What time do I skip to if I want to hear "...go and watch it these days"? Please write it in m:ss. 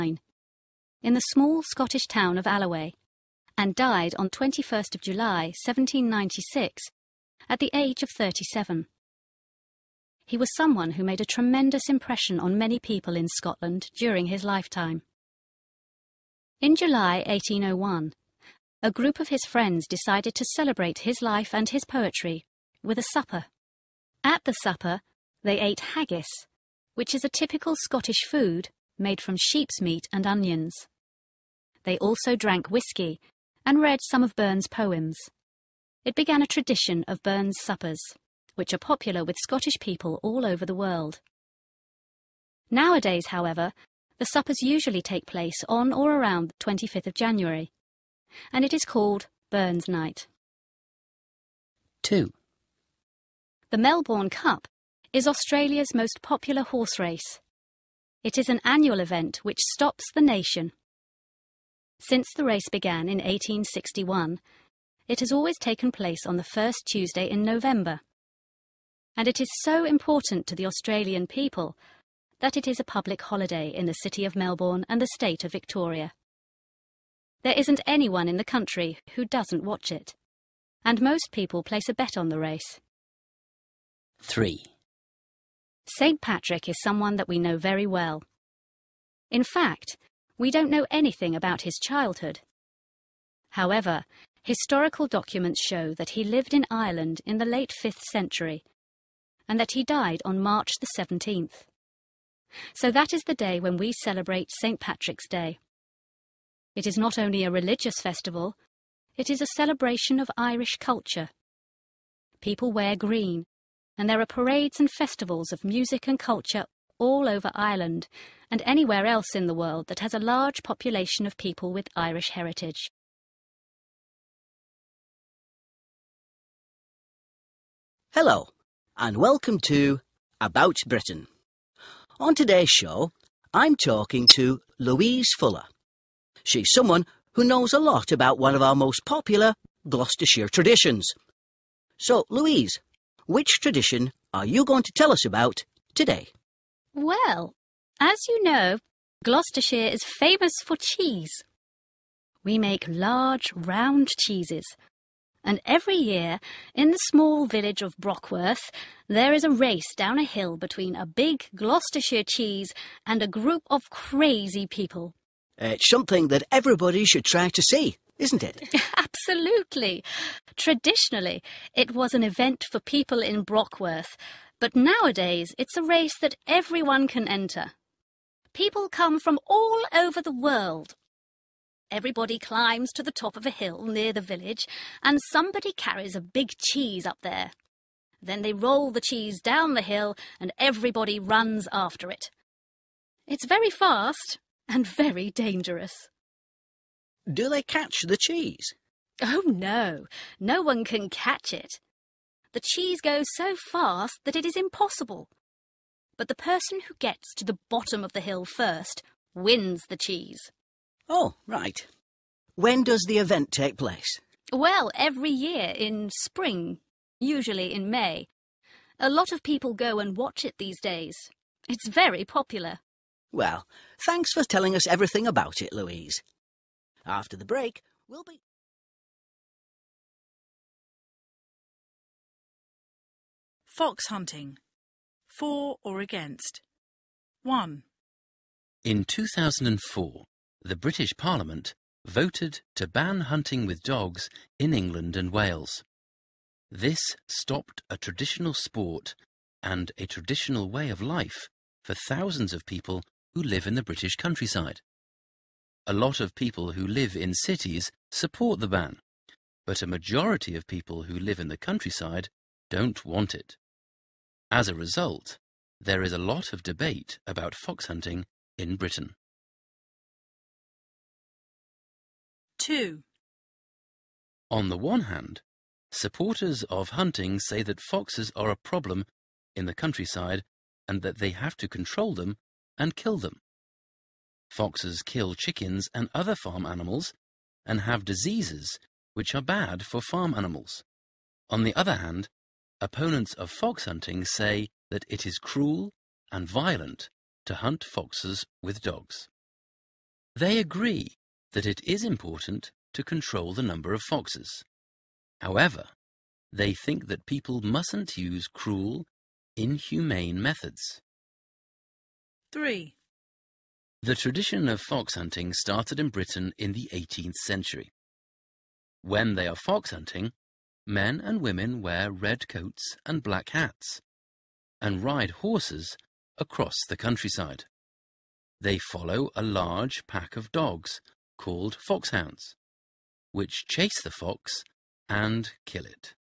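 3:39.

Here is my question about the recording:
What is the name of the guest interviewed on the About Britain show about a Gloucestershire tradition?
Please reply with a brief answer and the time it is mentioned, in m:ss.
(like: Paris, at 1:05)
Louise Fuller, at 2:14.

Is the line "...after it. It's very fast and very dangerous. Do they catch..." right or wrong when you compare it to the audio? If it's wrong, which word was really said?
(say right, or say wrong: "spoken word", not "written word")
right.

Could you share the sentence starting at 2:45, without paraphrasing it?
Uh, it's something that everybody should try to see, isn't it?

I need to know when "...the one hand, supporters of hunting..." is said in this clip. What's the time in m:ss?
4:34.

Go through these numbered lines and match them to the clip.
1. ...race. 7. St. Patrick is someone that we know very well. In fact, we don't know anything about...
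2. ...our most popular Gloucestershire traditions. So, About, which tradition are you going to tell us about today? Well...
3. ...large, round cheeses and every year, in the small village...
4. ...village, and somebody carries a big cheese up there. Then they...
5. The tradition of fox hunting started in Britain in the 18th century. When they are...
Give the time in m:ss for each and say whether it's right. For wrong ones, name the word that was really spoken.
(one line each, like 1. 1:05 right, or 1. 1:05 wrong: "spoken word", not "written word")
1. 1:22 wrong: "3", not "7"
2. 2:18 wrong: "Louise", not "About"
3. 2:32 right
4. 3:04 right
5. 5:14 right.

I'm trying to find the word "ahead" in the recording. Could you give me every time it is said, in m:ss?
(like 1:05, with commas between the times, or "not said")
not said.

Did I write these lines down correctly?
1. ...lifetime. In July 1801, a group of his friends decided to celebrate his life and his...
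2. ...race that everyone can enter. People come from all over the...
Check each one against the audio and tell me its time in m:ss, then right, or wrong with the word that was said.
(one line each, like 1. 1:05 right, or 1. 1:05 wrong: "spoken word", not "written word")
1. 0:14 right
2. 2:55 right.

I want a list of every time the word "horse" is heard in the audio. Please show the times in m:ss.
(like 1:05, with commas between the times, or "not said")
0:56, 5:25.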